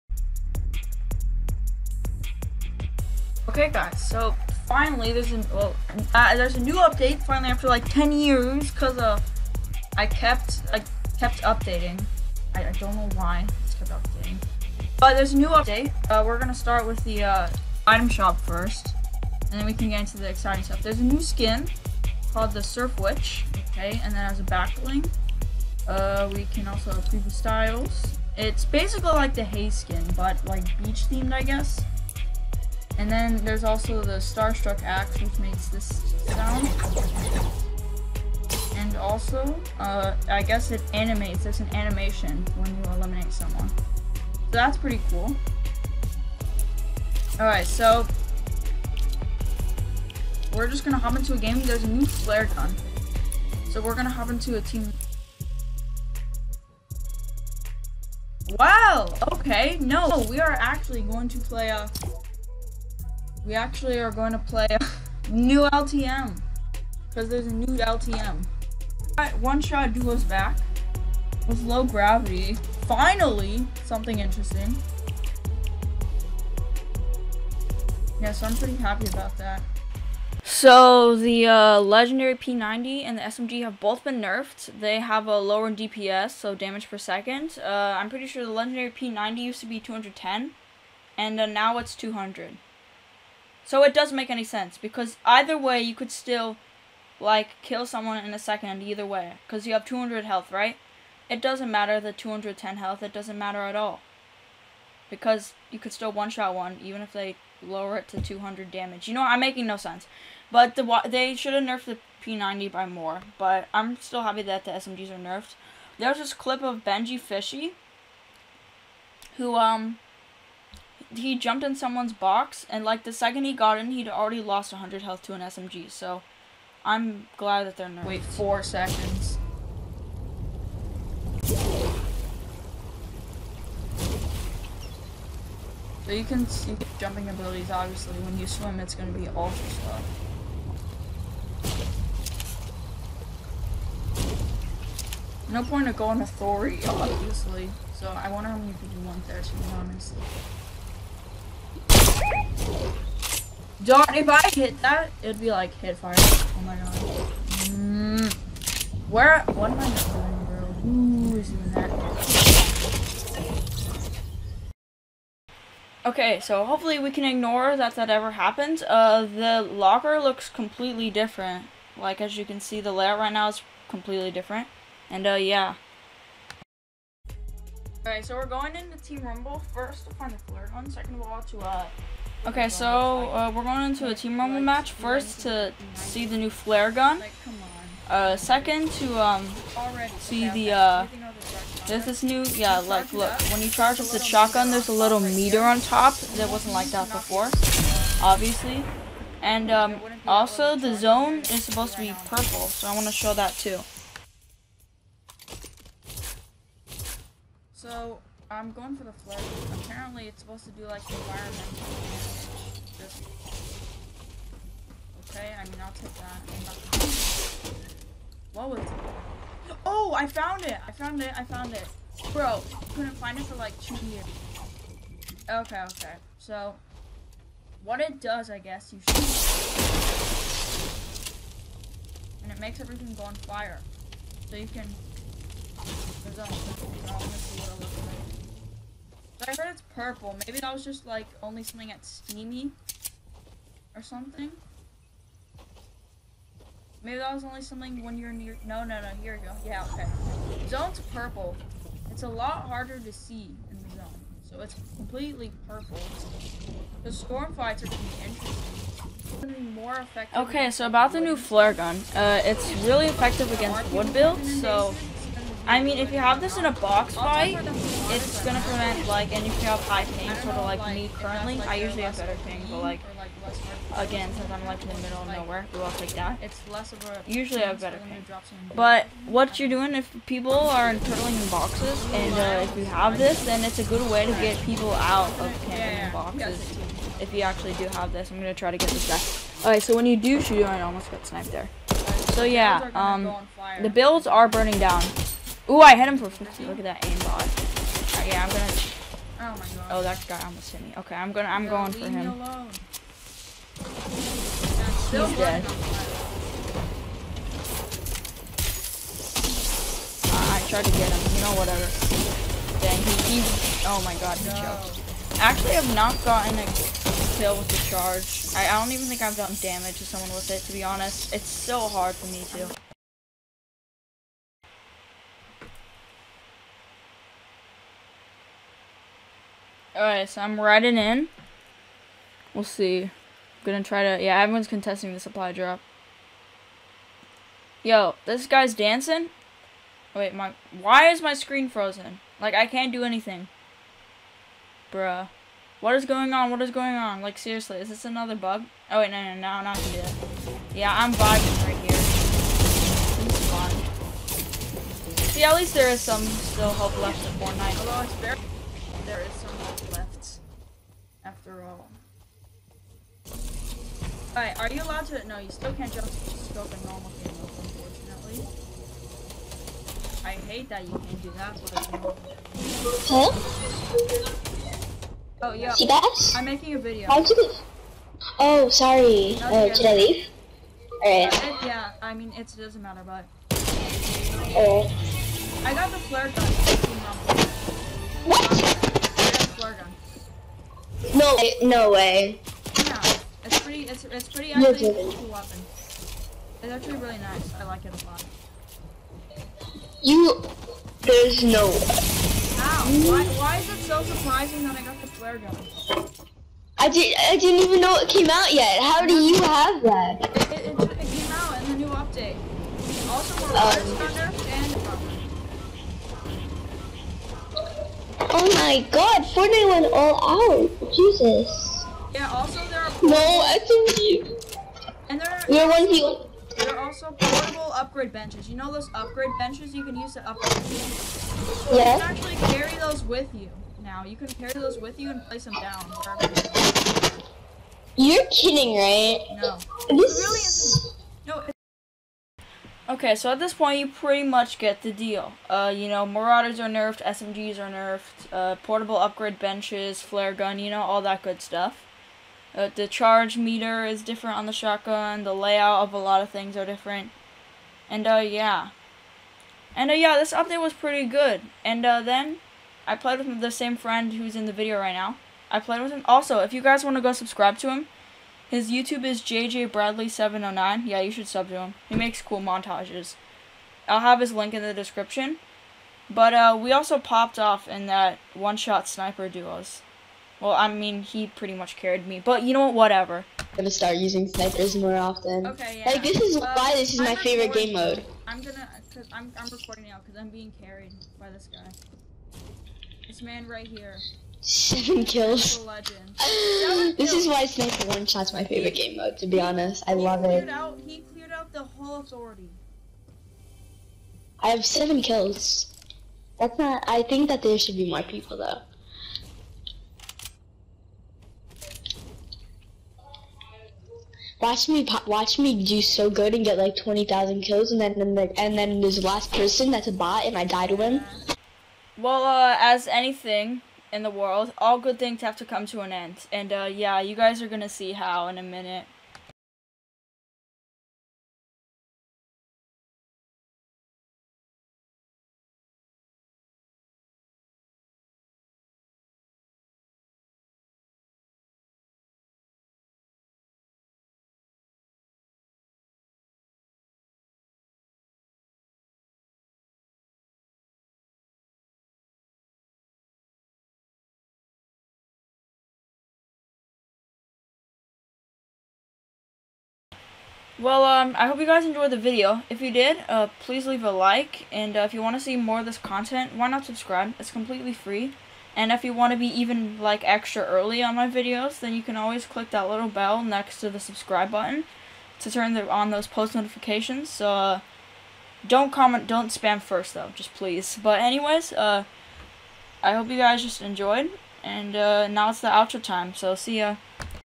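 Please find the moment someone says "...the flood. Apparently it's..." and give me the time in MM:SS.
03:29.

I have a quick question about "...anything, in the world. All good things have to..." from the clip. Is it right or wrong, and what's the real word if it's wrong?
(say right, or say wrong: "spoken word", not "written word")
right.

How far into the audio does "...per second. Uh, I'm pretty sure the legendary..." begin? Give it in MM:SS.
01:26.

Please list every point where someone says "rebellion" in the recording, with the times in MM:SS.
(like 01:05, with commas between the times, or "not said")
not said.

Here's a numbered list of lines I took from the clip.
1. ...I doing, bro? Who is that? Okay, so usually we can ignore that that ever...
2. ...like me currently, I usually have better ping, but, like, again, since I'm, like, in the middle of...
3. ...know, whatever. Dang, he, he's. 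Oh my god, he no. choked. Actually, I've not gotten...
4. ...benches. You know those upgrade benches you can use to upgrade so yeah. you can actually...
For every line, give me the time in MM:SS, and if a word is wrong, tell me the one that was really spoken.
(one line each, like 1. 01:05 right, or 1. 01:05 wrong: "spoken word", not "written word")
1. 02:39 wrong: "hopefully", not "usually"
2. 04:30 right
3. 05:11 right
4. 07:08 right.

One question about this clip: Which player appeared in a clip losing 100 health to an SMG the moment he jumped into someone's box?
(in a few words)
BenjyFishy.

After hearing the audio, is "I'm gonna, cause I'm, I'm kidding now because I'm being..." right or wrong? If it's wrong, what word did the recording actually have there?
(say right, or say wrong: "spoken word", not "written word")
wrong: "recording", not "kidding".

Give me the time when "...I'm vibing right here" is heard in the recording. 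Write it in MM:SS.
05:50.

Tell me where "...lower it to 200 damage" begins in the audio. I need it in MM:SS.
01:47.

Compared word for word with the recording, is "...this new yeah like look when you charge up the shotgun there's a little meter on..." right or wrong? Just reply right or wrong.
right.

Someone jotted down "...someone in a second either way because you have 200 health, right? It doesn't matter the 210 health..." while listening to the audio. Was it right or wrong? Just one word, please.
right.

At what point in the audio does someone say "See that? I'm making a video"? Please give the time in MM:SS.
06:15.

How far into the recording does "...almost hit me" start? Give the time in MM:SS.
05:00.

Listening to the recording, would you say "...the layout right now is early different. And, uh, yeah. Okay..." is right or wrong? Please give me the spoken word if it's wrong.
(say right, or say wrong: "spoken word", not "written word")
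wrong: "completely", not "early".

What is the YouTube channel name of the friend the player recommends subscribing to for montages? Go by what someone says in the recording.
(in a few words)
JJ Bradley 709.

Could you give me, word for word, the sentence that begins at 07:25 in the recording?
Uh, you know, Marauders are nerfed, SMGs are nerfed, uh, portable upgrade benches, flare gun, you know, all that good stuff.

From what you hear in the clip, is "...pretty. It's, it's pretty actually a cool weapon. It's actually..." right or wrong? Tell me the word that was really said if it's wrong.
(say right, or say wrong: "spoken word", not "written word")
right.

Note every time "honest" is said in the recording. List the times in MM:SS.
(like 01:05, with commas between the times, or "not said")
02:29, 05:20, 08:19.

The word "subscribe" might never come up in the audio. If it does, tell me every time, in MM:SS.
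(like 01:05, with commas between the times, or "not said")
07:47, 09:26, 09:33.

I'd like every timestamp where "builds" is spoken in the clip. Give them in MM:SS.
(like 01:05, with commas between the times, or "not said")
04:24, 04:53.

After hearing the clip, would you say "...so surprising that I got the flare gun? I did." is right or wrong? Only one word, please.
right.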